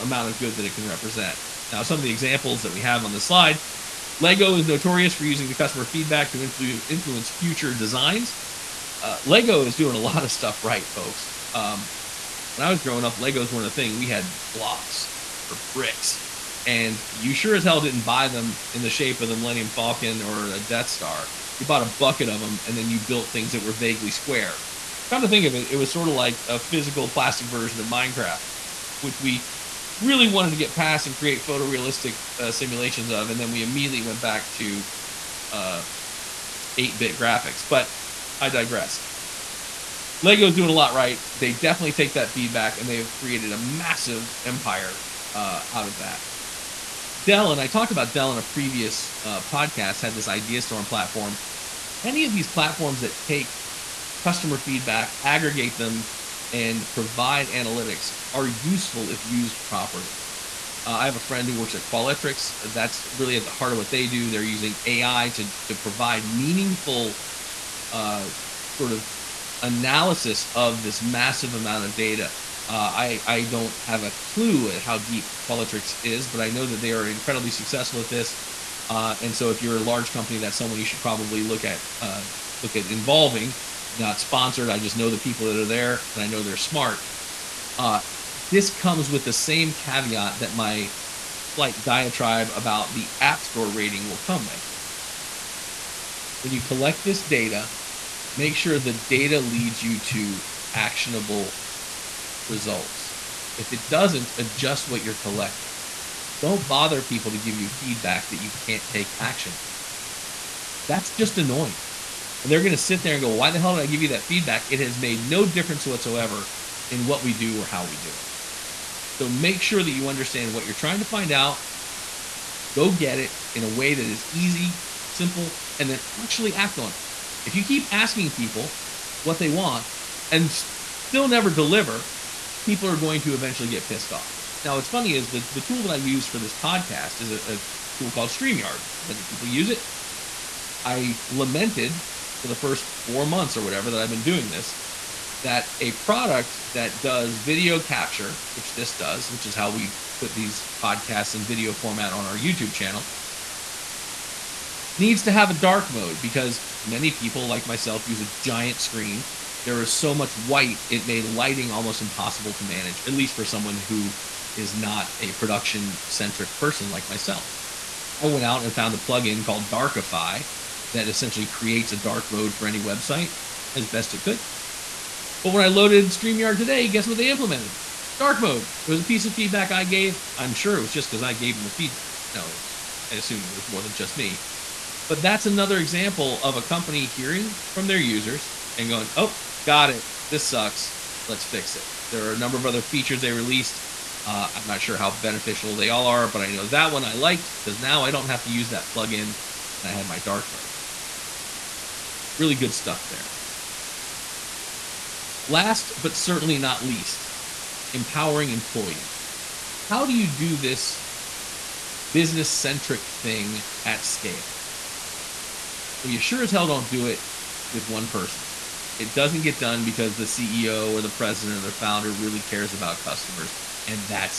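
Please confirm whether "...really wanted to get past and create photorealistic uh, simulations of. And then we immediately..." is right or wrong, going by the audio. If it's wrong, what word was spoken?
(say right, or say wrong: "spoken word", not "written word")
right.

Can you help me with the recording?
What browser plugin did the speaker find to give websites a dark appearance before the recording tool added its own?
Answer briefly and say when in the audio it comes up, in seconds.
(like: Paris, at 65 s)
Darkify, at 169 s.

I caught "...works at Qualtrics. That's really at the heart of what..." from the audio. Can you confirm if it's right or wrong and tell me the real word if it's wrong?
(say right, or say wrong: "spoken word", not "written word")
right.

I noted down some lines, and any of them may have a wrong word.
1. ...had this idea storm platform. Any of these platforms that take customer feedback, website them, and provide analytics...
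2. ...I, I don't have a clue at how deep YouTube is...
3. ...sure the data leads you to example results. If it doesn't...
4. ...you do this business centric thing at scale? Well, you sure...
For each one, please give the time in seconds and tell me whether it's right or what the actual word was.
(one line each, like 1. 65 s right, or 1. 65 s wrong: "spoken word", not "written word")
1. 50 s wrong: "aggregate", not "website"
2. 72 s wrong: "Qualtrics", not "YouTube"
3. 98 s wrong: "actionable", not "example"
4. 210 s right.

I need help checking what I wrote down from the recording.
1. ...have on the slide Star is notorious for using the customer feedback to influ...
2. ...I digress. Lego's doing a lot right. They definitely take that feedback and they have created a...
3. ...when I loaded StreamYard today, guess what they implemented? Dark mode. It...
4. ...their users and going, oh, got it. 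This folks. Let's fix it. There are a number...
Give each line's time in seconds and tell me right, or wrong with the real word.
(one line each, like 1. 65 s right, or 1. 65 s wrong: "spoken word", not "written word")
1. 2 s wrong: "Lego", not "Star"
2. 38 s right
3. 175 s right
4. 187 s wrong: "sucks", not "folks".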